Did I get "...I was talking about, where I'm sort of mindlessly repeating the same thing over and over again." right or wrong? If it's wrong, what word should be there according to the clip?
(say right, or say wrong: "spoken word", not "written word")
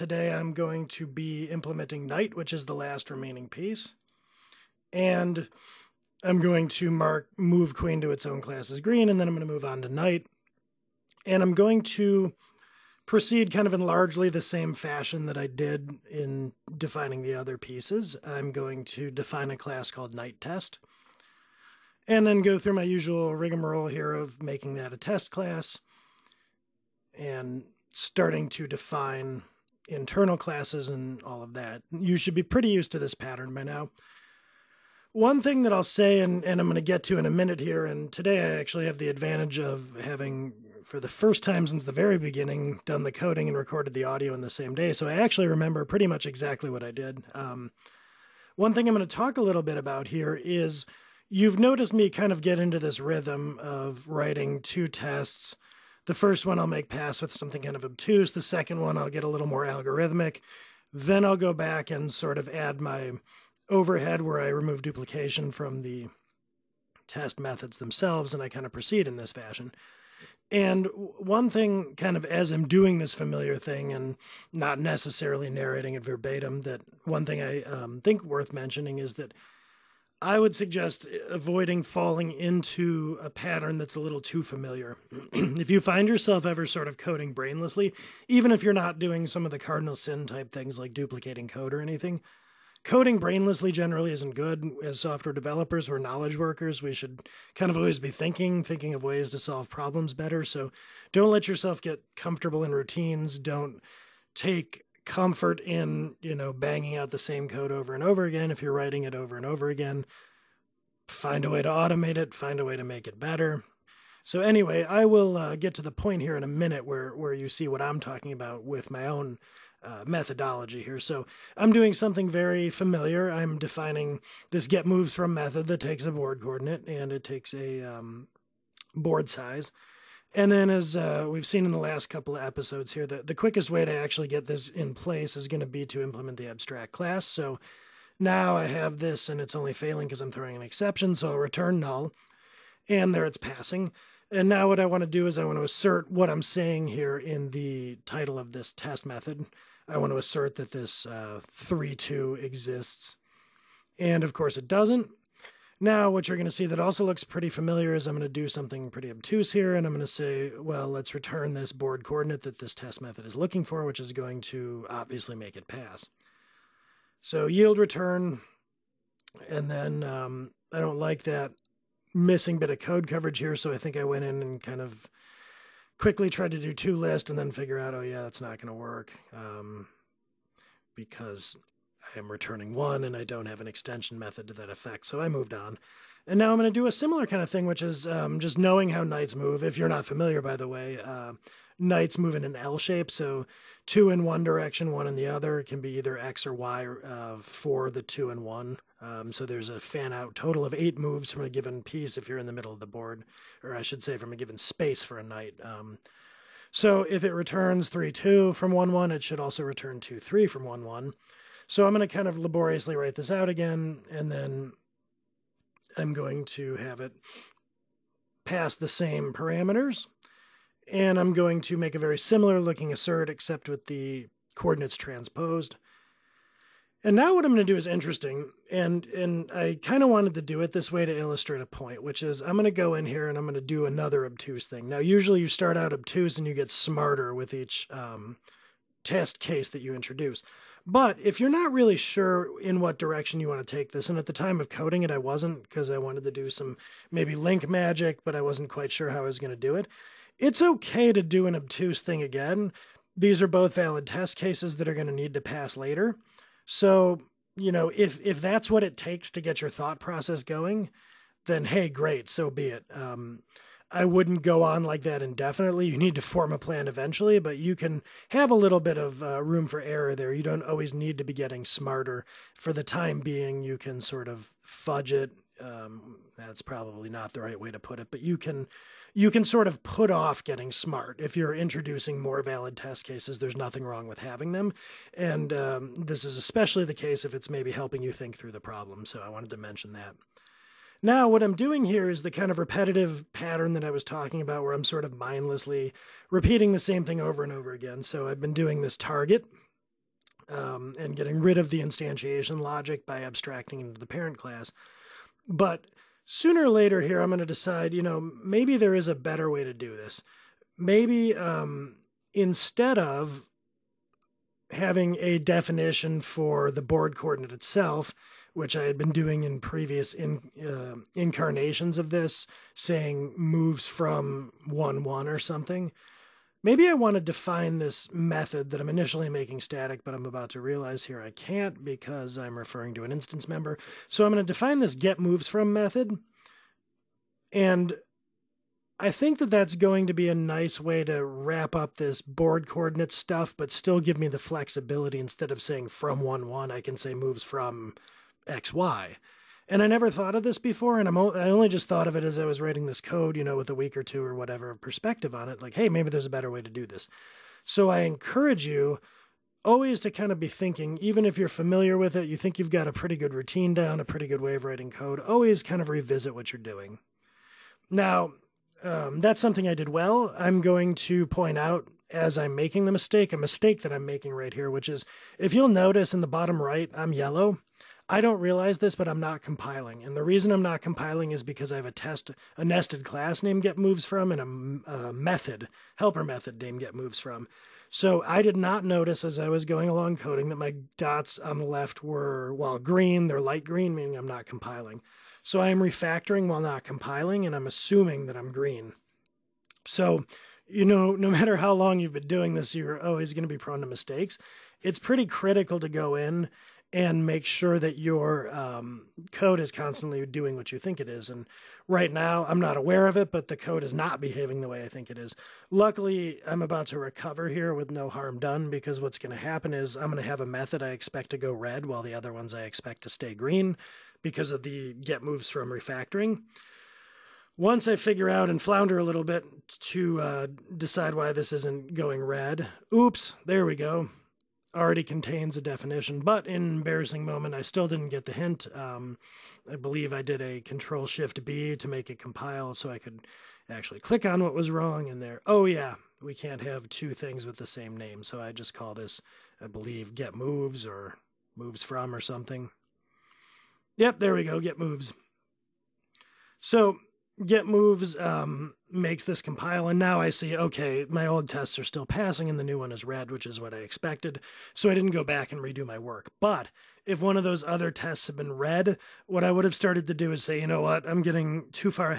right.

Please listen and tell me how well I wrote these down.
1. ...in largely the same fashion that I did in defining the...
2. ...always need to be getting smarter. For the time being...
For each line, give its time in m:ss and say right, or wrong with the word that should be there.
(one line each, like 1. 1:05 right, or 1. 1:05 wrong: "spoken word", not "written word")
1. 0:13 right
2. 4:30 right.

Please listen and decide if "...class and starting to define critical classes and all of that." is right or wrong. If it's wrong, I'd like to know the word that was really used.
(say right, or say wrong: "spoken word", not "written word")
wrong: "internal", not "critical".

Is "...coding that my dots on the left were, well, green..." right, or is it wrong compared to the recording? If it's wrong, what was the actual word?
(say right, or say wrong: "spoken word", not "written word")
right.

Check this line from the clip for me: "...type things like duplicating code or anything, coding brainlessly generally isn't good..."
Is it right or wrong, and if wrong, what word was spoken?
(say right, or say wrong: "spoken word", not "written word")
right.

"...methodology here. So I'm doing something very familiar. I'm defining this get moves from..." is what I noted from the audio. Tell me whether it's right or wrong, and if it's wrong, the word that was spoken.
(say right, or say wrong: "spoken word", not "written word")
right.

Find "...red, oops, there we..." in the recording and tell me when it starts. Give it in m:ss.
7:12.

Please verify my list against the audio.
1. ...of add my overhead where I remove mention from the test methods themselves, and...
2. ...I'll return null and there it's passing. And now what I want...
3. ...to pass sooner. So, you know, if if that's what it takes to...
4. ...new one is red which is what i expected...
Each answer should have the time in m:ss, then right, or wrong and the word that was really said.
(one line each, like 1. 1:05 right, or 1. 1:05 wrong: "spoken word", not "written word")
1. 1:02 wrong: "duplication", not "mention"
2. 2:21 right
3. 4:15 wrong: "later", not "sooner"
4. 7:42 right.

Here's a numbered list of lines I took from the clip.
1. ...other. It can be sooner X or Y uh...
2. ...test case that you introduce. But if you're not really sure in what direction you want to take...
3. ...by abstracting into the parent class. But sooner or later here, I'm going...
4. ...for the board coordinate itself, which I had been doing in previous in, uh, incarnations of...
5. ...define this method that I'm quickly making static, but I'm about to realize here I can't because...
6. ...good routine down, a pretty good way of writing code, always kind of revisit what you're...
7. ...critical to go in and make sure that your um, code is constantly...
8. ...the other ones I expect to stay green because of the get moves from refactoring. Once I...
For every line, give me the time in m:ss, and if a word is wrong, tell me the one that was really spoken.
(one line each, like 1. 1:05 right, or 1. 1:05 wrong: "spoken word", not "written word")
1. 3:15 wrong: "either", not "sooner"
2. 3:59 right
3. 5:03 right
4. 5:16 right
5. 5:27 wrong: "initially", not "quickly"
6. 6:03 right
7. 6:45 right
8. 7:02 right.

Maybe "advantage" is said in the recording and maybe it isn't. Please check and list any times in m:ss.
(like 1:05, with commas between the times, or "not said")
0:39.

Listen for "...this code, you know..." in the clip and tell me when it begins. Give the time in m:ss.
5:52.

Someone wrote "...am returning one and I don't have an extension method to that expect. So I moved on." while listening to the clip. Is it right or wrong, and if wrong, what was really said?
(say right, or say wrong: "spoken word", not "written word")
wrong: "effect", not "expect".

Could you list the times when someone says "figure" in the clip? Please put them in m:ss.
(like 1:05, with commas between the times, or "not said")
2:57, 7:07.